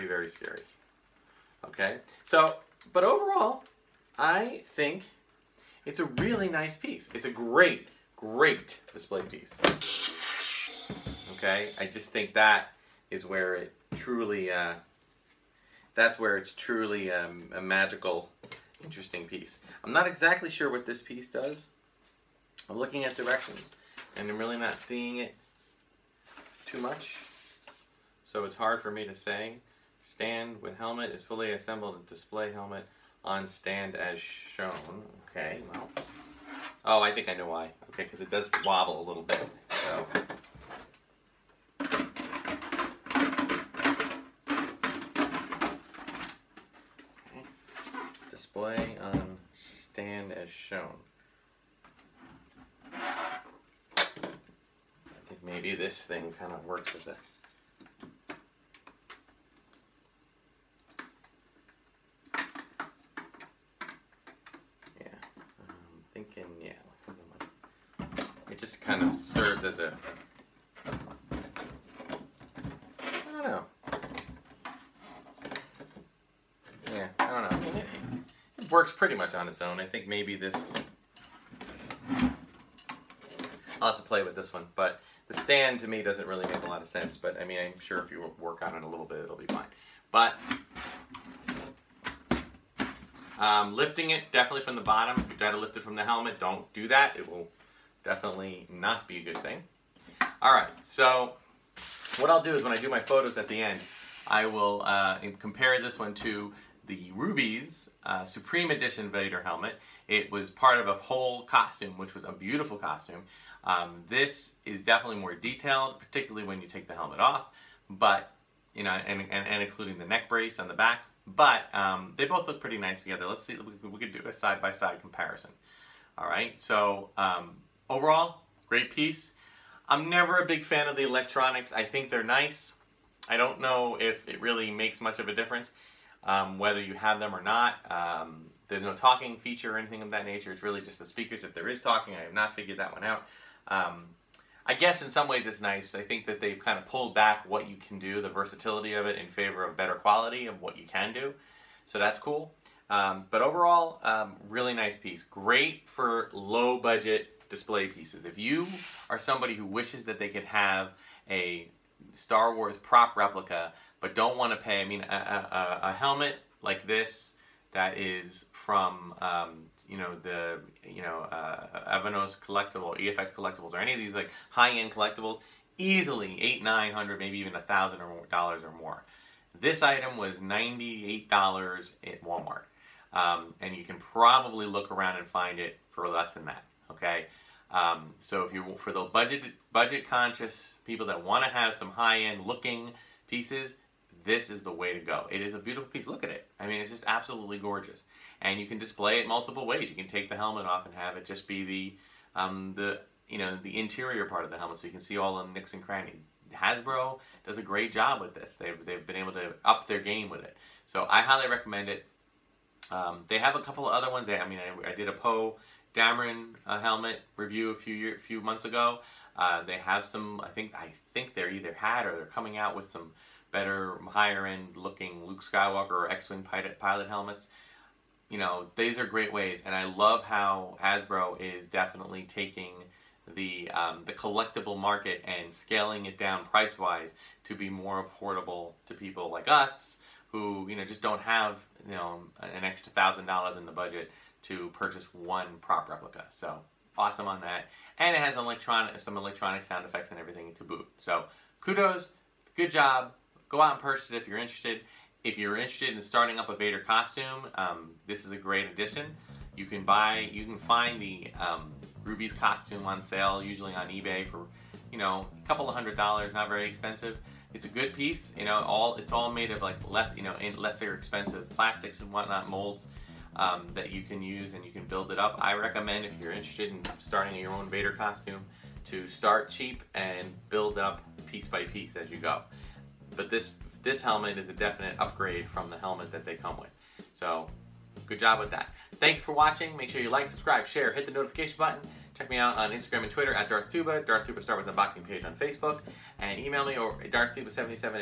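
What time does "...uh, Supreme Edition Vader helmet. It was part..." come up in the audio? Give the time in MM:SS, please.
01:48.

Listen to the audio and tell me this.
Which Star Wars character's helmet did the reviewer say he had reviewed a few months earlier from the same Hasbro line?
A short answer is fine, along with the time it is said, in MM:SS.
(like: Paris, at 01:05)
Poe Dameron, at 03:35.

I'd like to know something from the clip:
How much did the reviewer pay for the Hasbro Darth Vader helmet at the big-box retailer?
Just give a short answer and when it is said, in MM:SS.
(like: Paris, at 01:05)
$98, at 03:00.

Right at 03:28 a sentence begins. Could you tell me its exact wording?
They've they've been able to up their game with it.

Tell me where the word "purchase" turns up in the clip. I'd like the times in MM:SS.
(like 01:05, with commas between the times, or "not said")
04:04, 04:13.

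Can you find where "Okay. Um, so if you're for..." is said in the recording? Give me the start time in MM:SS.
03:06.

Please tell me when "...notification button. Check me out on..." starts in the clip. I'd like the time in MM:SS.
04:51.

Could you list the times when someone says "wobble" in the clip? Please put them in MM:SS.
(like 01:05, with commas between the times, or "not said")
00:38.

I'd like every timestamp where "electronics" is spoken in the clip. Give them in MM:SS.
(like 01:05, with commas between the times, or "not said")
02:11, 04:09.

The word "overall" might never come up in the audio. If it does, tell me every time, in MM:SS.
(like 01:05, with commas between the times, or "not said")
00:03, 02:07, 02:33.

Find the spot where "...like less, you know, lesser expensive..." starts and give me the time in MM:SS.
04:29.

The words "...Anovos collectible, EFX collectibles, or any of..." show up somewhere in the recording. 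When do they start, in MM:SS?
02:52.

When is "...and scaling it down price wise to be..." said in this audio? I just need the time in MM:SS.
03:55.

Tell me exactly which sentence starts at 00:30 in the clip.
Stand with helmet is fully assembled display helmet on stand as shown.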